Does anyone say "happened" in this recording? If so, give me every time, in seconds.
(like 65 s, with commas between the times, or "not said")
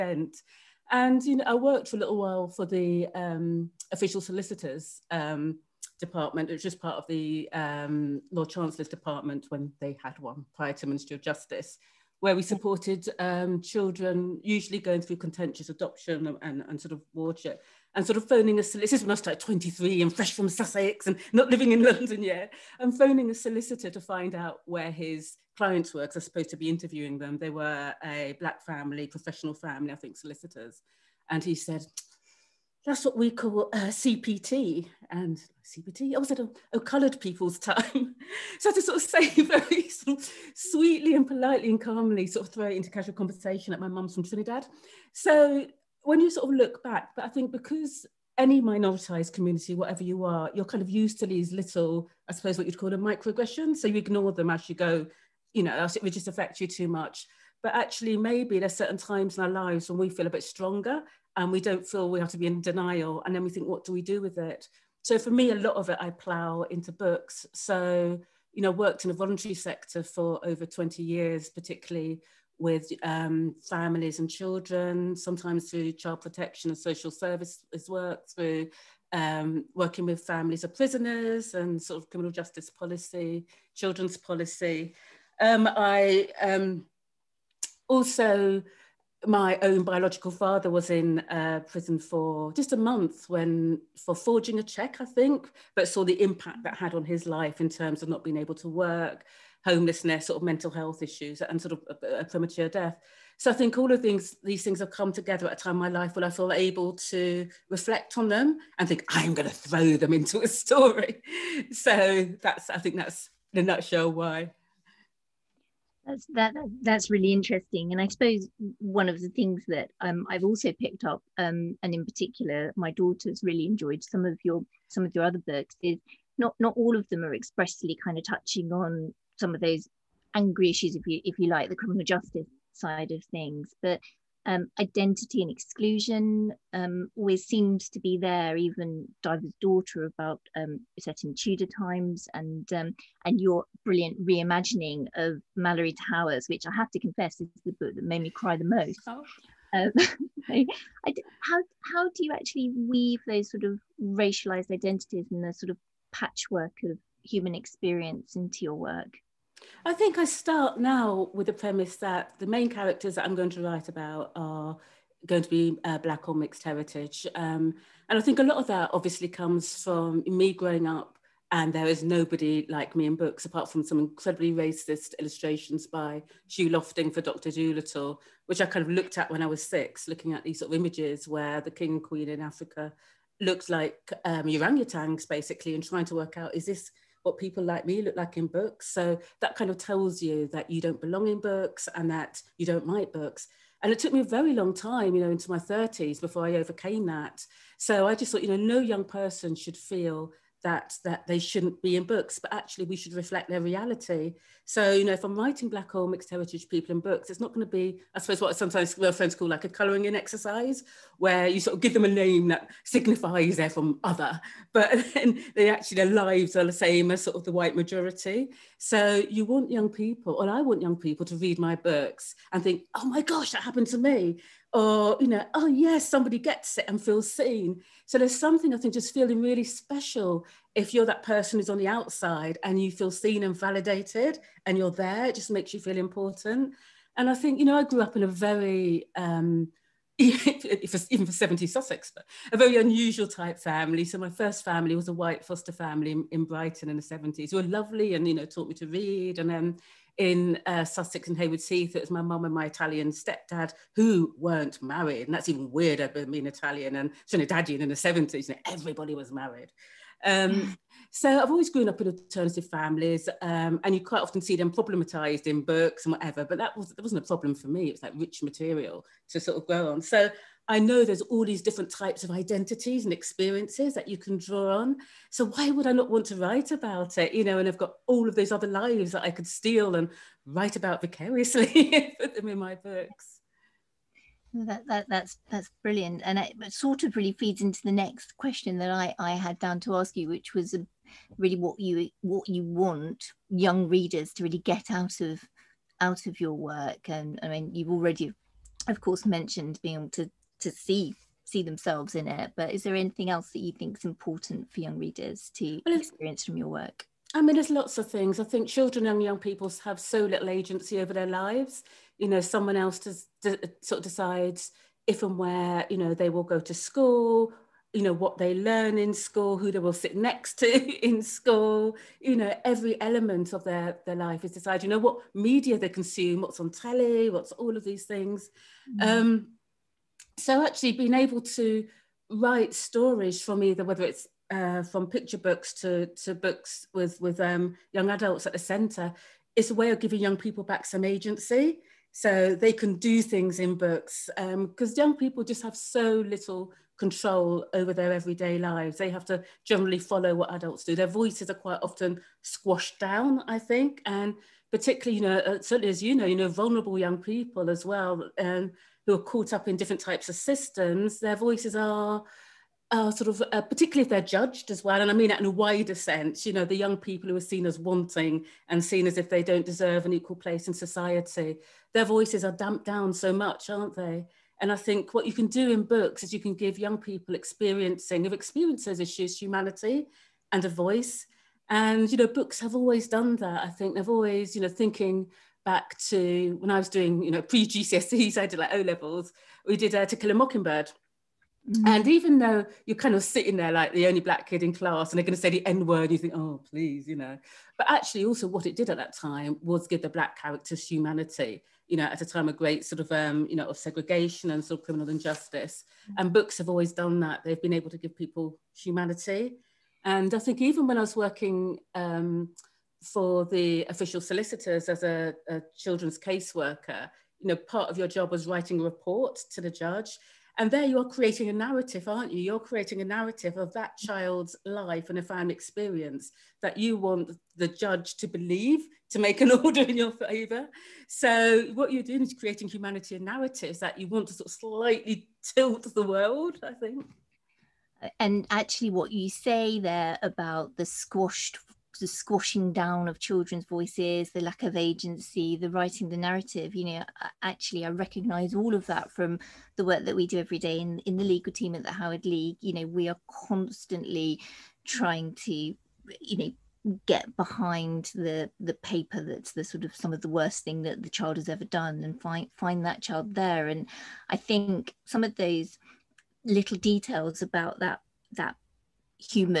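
223 s.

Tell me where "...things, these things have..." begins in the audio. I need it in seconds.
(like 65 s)
104 s.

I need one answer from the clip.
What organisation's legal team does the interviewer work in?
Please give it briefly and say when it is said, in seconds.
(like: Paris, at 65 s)
Howard League, at 451 s.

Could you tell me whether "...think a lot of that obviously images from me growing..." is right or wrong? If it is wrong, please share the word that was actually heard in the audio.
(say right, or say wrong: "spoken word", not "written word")
wrong: "comes", not "images".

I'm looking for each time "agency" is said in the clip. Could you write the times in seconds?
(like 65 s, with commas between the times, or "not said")
310 s, 341 s, 444 s.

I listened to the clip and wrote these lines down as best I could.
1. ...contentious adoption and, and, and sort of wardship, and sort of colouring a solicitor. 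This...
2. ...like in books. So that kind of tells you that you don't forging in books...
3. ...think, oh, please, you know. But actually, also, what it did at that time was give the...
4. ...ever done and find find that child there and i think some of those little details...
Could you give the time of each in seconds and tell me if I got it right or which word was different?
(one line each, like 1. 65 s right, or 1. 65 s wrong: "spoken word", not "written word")
1. 15 s wrong: "phoning", not "colouring"
2. 188 s wrong: "belong", not "forging"
3. 396 s right
4. 461 s right.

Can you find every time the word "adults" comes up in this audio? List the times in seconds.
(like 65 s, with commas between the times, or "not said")
338 s, 350 s.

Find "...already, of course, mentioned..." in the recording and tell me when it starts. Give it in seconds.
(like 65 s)
297 s.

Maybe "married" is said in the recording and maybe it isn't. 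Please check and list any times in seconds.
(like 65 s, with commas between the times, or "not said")
254 s, 259 s.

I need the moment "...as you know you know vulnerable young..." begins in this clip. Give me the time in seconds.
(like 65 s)
355 s.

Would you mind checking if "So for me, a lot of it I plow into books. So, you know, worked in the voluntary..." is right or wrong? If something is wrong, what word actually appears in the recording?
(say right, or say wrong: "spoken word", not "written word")
right.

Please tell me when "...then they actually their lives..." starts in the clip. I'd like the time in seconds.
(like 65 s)
215 s.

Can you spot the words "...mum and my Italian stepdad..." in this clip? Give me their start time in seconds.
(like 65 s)
252 s.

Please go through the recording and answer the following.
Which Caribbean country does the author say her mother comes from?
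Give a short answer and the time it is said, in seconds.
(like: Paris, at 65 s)
Trinidad, at 44 s.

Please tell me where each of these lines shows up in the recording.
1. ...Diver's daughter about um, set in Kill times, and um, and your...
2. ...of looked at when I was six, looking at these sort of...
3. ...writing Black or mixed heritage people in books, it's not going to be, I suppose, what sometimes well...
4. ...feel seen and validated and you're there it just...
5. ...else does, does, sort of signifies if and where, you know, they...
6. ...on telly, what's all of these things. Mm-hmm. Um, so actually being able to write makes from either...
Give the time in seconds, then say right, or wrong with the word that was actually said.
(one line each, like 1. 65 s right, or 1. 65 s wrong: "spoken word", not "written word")
1. 139 s wrong: "Tudor", not "Kill"
2. 178 s right
3. 205 s right
4. 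232 s right
5. 312 s wrong: "decides", not "signifies"
6. 326 s wrong: "stories", not "makes".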